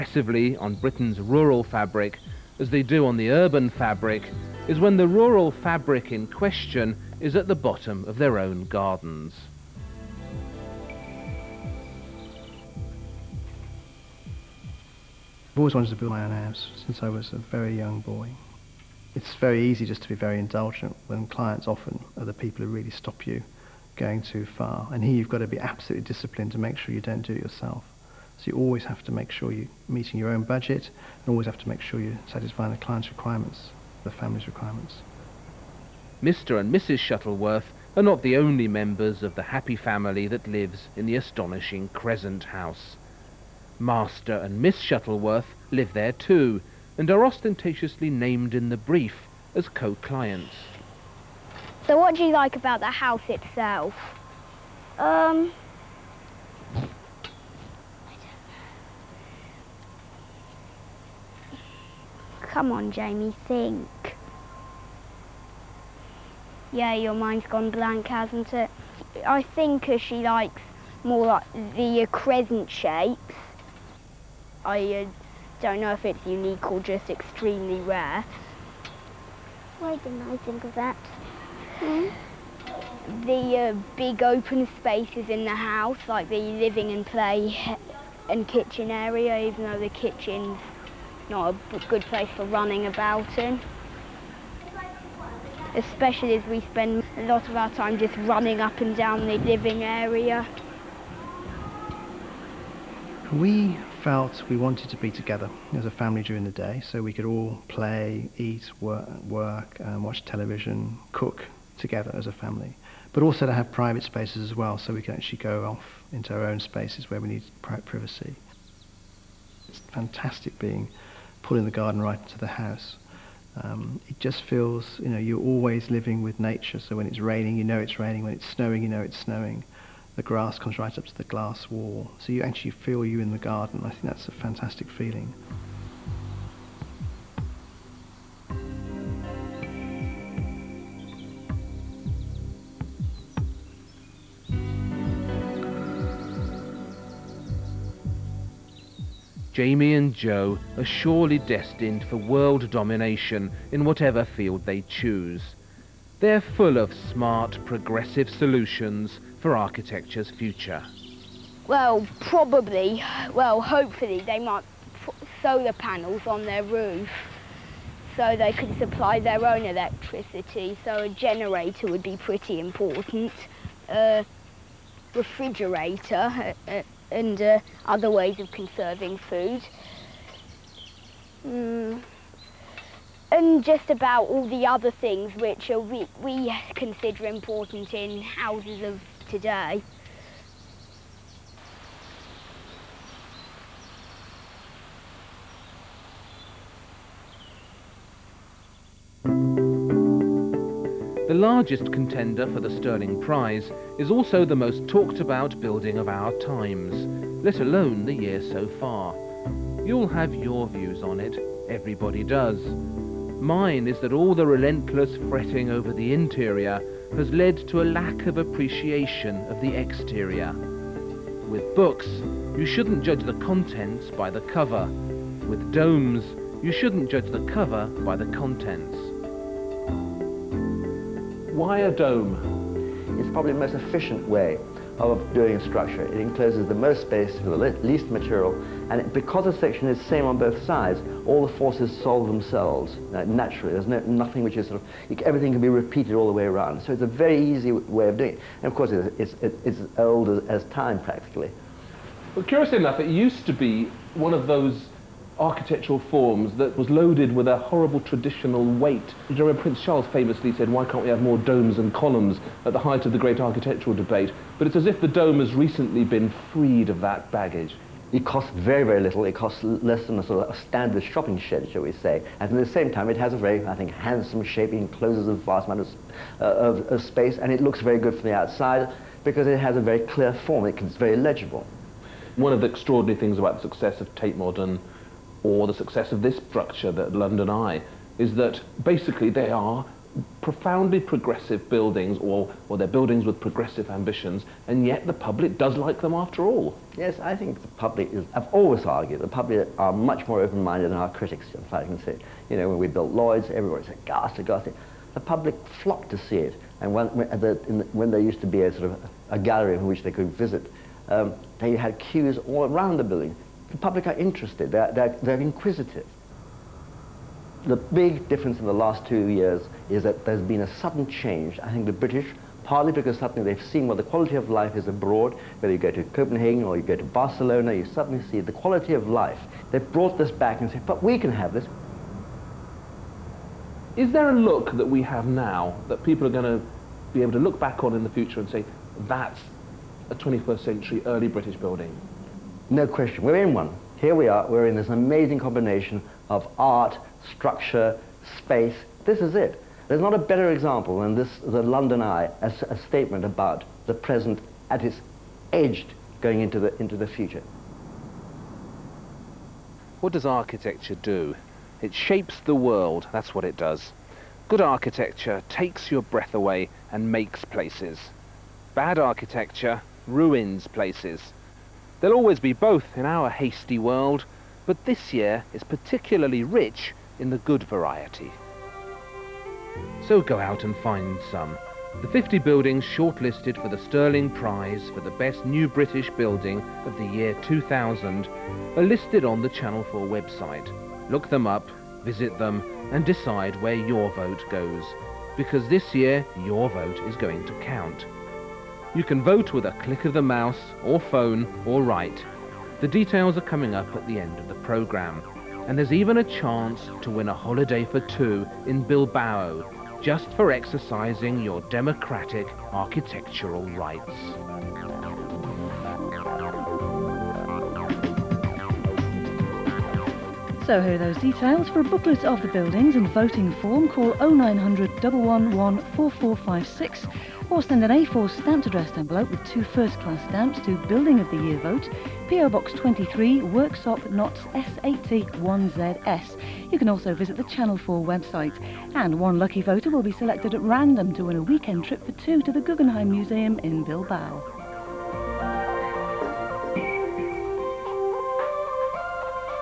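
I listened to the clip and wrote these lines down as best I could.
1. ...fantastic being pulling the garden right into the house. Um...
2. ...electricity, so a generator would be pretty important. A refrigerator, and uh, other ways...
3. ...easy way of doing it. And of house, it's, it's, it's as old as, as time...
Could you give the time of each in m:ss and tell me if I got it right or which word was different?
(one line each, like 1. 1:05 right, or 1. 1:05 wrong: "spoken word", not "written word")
1. 1:59 right
2. 2:49 right
3. 4:07 wrong: "course", not "house".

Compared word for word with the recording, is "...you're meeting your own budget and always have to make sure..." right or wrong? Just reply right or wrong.
right.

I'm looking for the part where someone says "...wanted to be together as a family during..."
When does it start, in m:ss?
1:44.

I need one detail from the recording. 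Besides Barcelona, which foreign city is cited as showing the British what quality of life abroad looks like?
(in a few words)
Copenhagen.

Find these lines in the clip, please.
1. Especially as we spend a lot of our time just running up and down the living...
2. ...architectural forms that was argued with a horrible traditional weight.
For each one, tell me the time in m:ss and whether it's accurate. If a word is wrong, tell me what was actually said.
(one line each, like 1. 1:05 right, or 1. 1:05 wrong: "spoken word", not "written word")
1. 1:35 right
2. 4:15 wrong: "loaded", not "argued".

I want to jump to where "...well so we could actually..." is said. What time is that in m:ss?
1:54.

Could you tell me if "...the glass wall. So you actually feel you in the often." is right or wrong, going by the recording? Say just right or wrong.
wrong.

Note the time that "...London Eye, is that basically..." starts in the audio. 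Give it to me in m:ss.
4:47.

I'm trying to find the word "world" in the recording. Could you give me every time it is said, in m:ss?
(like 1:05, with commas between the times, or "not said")
2:32, 6:02, 6:13.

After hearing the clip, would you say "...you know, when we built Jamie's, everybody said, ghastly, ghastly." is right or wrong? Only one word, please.
wrong.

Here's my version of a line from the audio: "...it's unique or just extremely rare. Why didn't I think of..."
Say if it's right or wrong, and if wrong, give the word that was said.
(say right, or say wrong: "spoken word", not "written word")
right.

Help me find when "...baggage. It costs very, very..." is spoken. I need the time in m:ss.
4:27.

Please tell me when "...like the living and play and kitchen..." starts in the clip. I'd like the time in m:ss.
1:26.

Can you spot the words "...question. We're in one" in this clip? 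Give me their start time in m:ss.
5:42.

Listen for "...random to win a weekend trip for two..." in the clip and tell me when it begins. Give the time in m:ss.
7:20.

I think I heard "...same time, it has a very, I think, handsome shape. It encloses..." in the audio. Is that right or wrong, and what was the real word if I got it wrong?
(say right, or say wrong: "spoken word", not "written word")
right.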